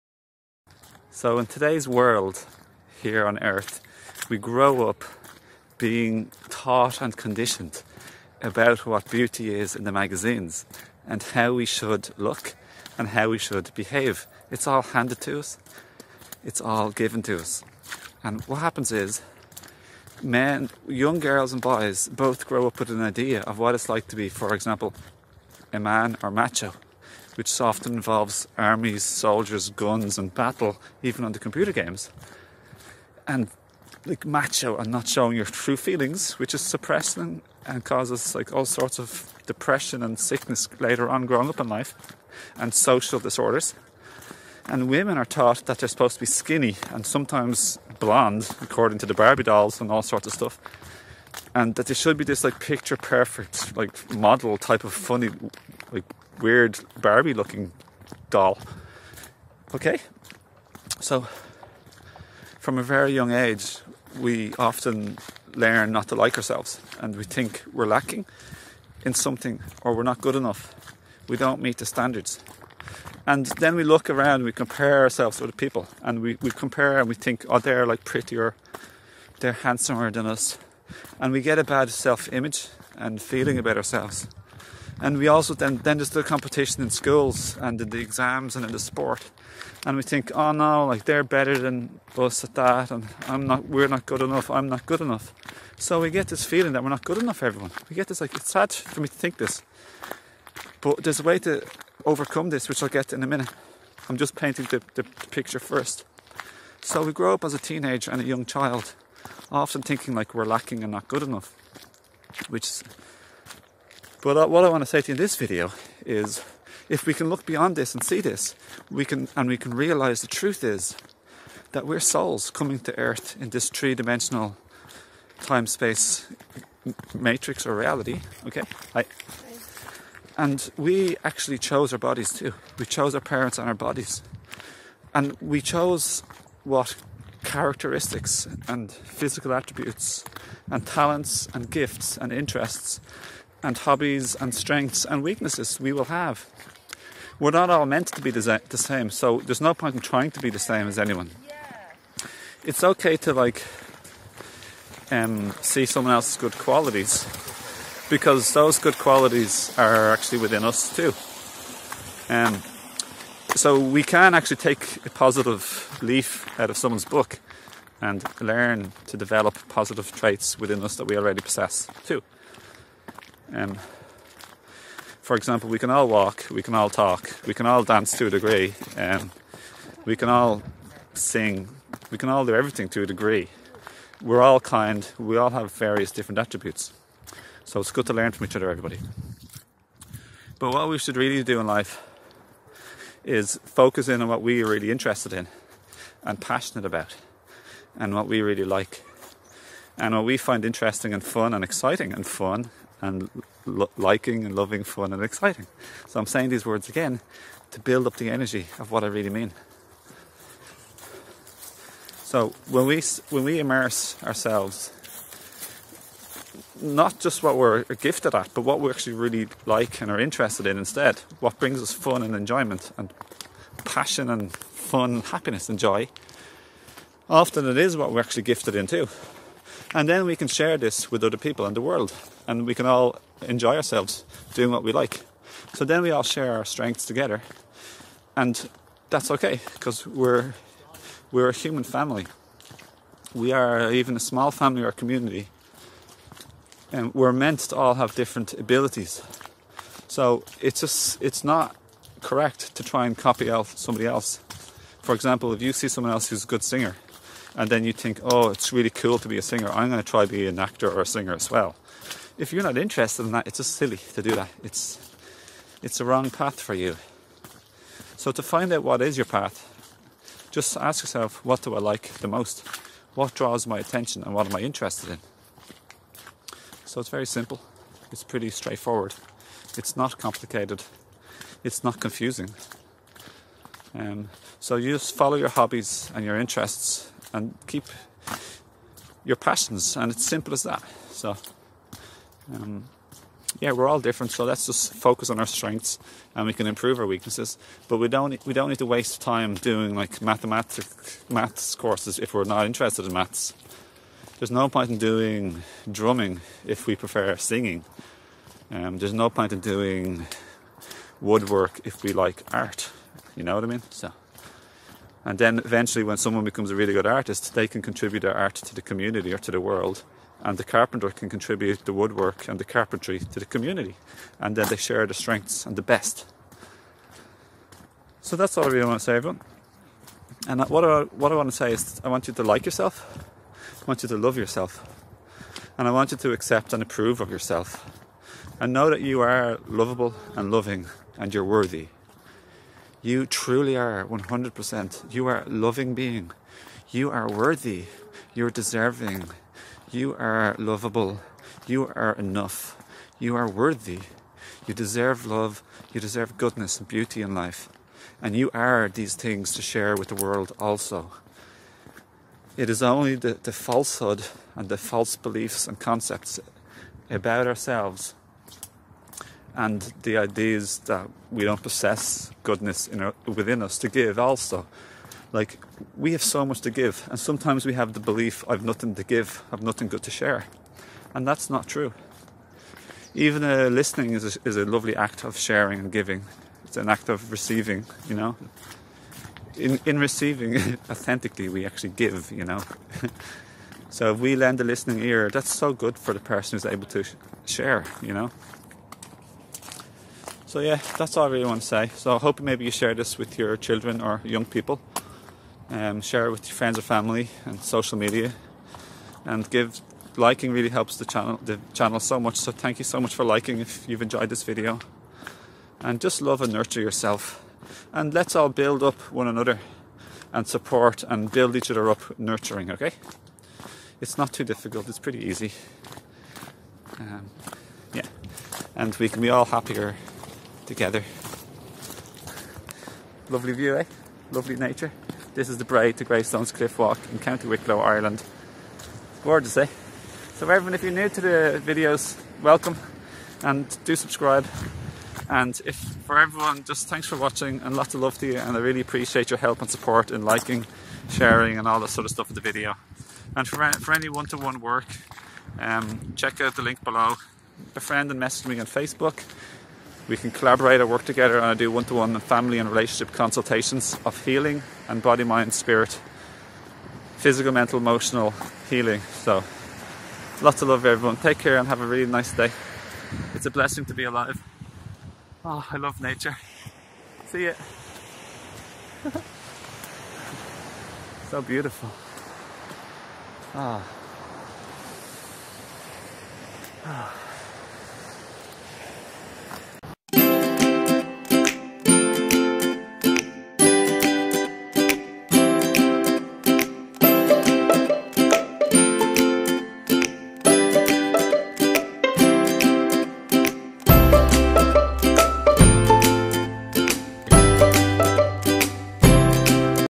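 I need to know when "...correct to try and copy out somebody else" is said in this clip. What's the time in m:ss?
4:12.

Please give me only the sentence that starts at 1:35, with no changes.
So we get this feeling that we're not good enough everyone.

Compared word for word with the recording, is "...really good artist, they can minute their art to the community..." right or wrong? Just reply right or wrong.
wrong.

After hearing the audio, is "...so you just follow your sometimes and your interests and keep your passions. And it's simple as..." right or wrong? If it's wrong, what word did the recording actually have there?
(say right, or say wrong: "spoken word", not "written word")
wrong: "hobbies", not "sometimes".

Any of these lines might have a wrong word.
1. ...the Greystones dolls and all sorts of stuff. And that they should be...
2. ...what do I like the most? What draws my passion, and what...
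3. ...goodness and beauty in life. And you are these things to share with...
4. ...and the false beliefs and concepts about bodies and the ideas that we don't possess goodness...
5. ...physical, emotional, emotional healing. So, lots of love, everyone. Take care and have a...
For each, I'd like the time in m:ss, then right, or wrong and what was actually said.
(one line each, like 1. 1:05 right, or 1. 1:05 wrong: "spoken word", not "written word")
1. 0:49 wrong: "Barbie", not "Greystones"
2. 4:31 wrong: "attention", not "passion"
3. 5:56 right
4. 6:04 wrong: "ourselves", not "bodies"
5. 7:47 wrong: "mental", not "emotional".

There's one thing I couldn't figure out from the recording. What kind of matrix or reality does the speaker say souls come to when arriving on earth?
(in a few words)
three-dimensional time-space.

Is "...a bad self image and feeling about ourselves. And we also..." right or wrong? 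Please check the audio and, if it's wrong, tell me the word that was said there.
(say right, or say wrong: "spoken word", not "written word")
right.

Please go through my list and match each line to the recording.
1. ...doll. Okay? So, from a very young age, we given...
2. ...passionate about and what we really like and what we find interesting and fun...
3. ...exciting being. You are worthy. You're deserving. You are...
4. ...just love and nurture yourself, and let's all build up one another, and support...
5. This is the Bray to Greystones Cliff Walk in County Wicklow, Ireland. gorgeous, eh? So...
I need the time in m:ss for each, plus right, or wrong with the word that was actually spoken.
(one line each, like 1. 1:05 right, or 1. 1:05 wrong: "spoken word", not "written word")
1. 0:58 wrong: "often", not "given"
2. 3:16 right
3. 5:45 wrong: "loving", not "exciting"
4. 6:56 right
5. 7:15 right.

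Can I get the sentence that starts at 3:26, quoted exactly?
So I'm saying these words again to build up the energy of what I really mean.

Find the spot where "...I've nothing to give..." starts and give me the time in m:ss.
6:18.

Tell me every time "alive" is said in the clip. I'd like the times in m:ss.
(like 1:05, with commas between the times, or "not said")
7:54.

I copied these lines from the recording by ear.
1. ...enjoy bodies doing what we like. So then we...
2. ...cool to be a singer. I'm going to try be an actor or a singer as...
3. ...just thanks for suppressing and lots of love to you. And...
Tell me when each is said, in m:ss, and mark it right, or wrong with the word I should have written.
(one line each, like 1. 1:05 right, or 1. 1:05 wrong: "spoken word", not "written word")
1. 3:53 wrong: "ourselves", not "bodies"
2. 4:18 right
3. 7:26 wrong: "watching", not "suppressing".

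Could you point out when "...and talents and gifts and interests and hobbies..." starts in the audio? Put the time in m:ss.
2:20.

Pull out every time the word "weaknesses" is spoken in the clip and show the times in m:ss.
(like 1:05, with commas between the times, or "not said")
2:25, 4:57.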